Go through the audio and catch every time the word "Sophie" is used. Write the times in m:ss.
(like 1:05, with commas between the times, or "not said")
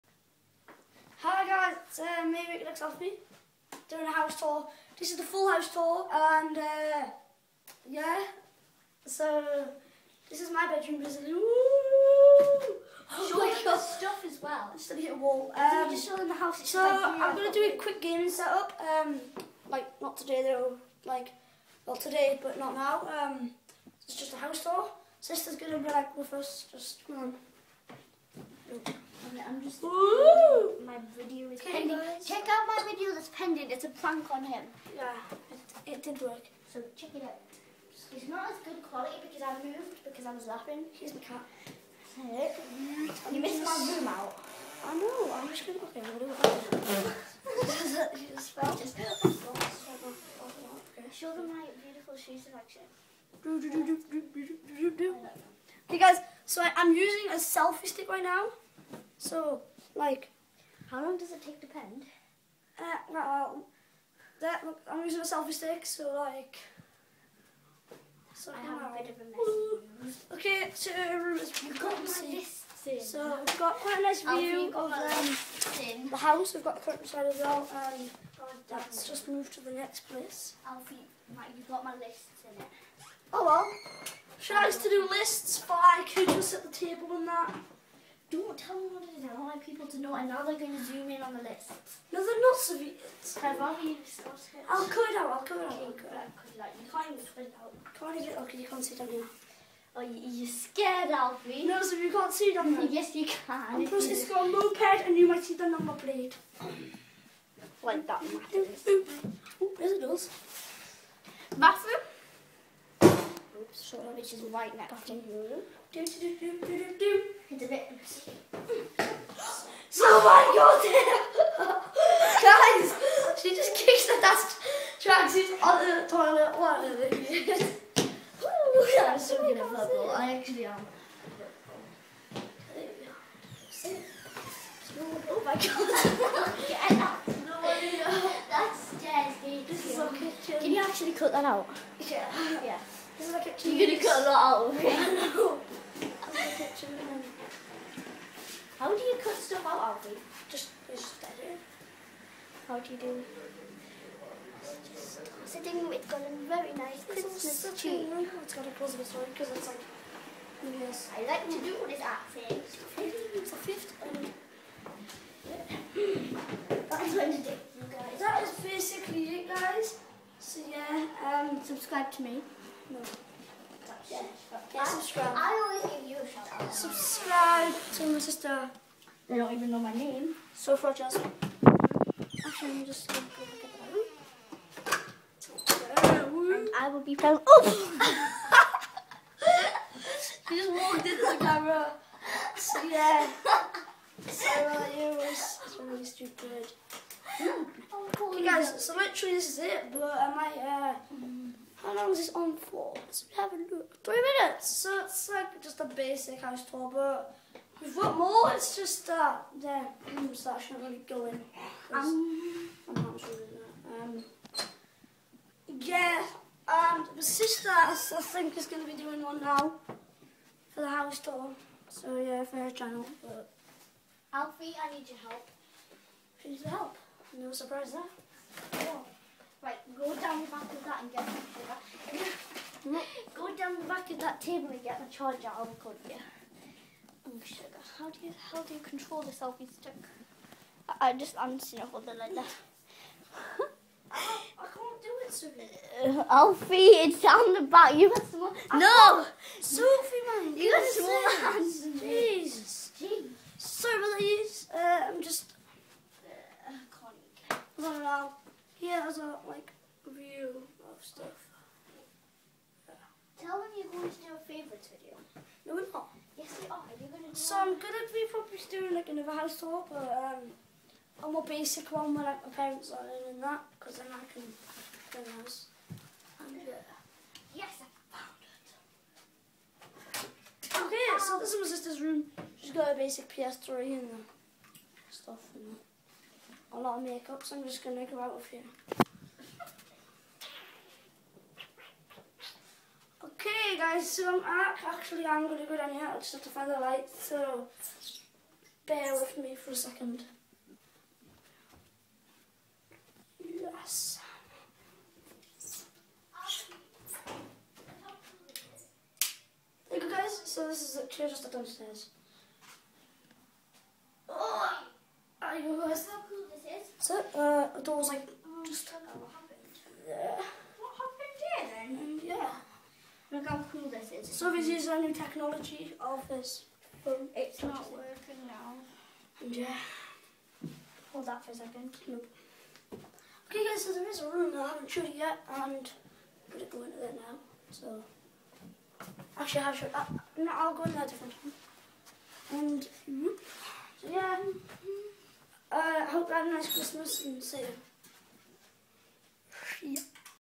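4:05, 4:09.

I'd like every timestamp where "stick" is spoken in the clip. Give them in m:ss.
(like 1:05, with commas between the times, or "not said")
0:57, 1:05, 3:59.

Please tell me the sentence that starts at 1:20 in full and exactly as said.
Alfie, you've got my lists in it.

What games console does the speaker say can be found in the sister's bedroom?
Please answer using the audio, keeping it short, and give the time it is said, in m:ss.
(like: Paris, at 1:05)
PS3, at 4:43.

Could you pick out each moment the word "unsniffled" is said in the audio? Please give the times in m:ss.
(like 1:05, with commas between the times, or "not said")
4:01.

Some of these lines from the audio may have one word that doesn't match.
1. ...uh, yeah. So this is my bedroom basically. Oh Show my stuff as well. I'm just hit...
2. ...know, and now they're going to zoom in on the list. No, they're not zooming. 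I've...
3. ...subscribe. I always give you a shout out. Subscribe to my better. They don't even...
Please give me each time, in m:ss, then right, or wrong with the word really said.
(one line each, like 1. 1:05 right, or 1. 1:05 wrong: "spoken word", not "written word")
1. 0:06 right
2. 1:29 right
3. 2:54 wrong: "sister", not "better".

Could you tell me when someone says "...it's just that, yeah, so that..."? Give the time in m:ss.
3:28.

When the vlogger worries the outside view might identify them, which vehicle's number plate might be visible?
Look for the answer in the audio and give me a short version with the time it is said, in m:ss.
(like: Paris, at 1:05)
moped, at 1:44.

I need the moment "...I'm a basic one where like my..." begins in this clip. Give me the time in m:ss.
4:31.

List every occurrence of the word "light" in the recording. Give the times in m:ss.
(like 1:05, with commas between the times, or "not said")
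4:56.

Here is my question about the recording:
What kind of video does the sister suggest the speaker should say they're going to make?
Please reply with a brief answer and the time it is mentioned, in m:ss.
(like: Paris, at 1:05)
favorites video, at 4:24.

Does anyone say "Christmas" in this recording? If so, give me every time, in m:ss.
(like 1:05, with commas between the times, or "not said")
2:37, 5:46.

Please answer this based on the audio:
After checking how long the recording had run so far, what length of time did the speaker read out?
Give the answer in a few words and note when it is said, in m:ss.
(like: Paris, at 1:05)
3 minutes, at 3:24.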